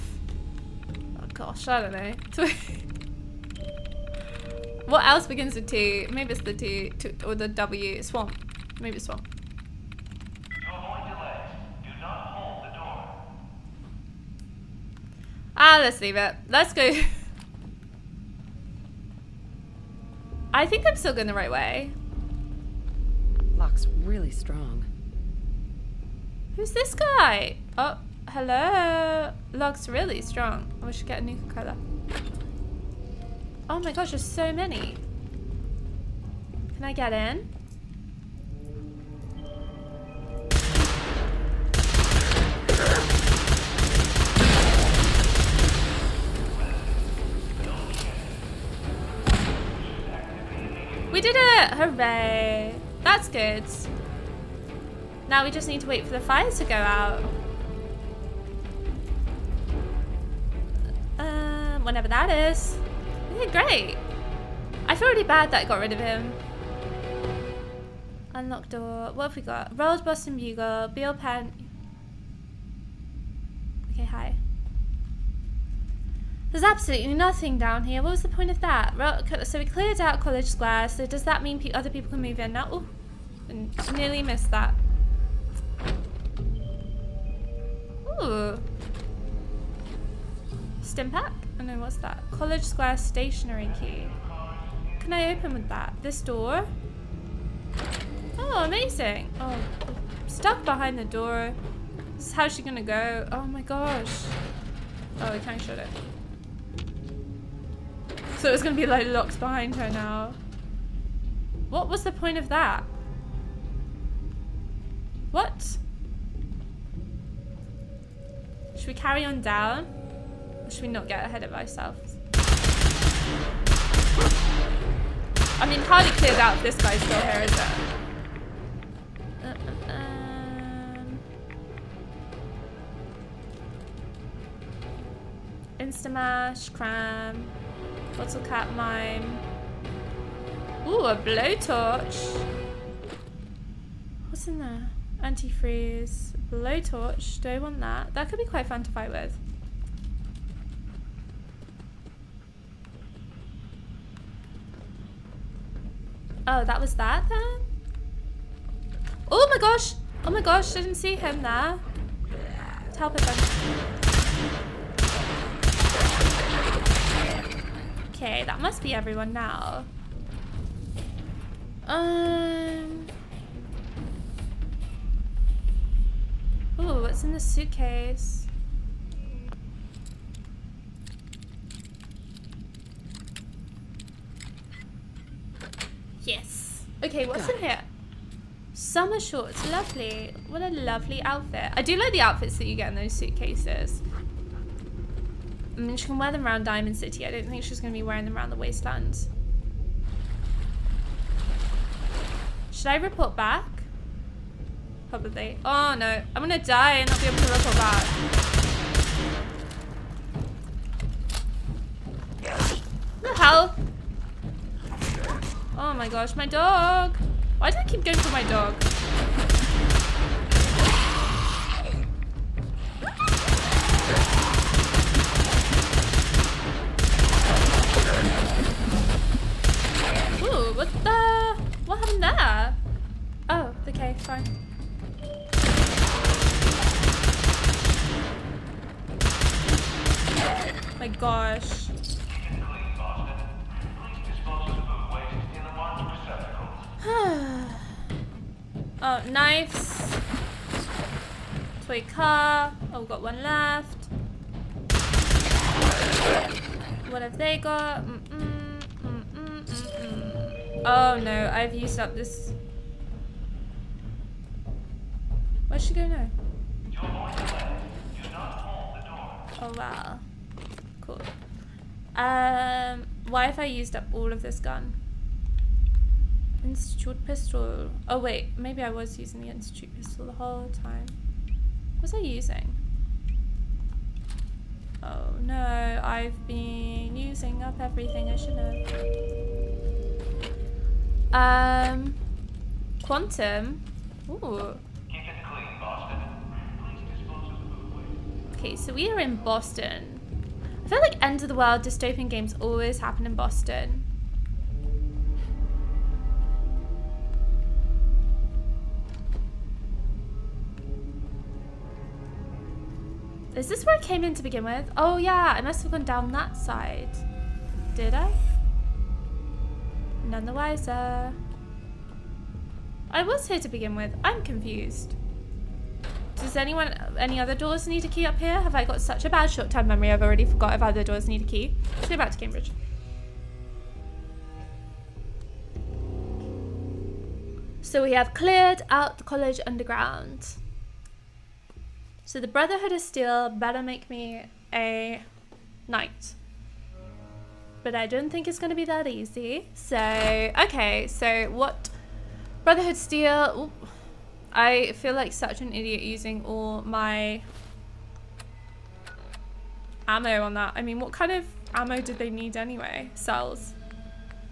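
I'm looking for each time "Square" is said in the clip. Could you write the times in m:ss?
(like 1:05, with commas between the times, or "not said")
1:20, 1:32.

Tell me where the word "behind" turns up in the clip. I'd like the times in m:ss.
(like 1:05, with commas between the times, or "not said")
1:40, 1:49.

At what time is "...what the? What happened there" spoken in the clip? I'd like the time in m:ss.
3:50.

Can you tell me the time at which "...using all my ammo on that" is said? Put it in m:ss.
5:56.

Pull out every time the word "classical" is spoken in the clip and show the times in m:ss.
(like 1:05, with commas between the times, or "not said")
not said.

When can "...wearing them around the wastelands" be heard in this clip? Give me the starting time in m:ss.
3:18.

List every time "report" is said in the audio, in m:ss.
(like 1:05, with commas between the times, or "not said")
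3:22, 3:27.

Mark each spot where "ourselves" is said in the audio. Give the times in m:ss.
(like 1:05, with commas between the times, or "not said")
2:01.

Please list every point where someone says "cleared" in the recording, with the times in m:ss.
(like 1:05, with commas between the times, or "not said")
1:19, 2:06, 5:38.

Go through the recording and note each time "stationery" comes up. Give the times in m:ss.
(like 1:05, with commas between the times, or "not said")
1:32.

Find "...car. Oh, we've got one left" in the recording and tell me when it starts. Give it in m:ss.
4:12.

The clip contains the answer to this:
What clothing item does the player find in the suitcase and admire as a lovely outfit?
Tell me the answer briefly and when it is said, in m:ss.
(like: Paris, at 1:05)
Summer shorts, at 3:08.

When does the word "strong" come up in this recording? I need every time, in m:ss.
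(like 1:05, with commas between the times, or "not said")
0:24, 0:30.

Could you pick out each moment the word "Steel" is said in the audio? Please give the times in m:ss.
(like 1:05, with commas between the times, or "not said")
5:42, 5:52.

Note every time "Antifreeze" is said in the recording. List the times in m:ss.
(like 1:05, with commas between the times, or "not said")
2:25.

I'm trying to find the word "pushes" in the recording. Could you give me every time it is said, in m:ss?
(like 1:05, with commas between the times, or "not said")
not said.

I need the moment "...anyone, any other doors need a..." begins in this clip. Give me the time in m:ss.
5:26.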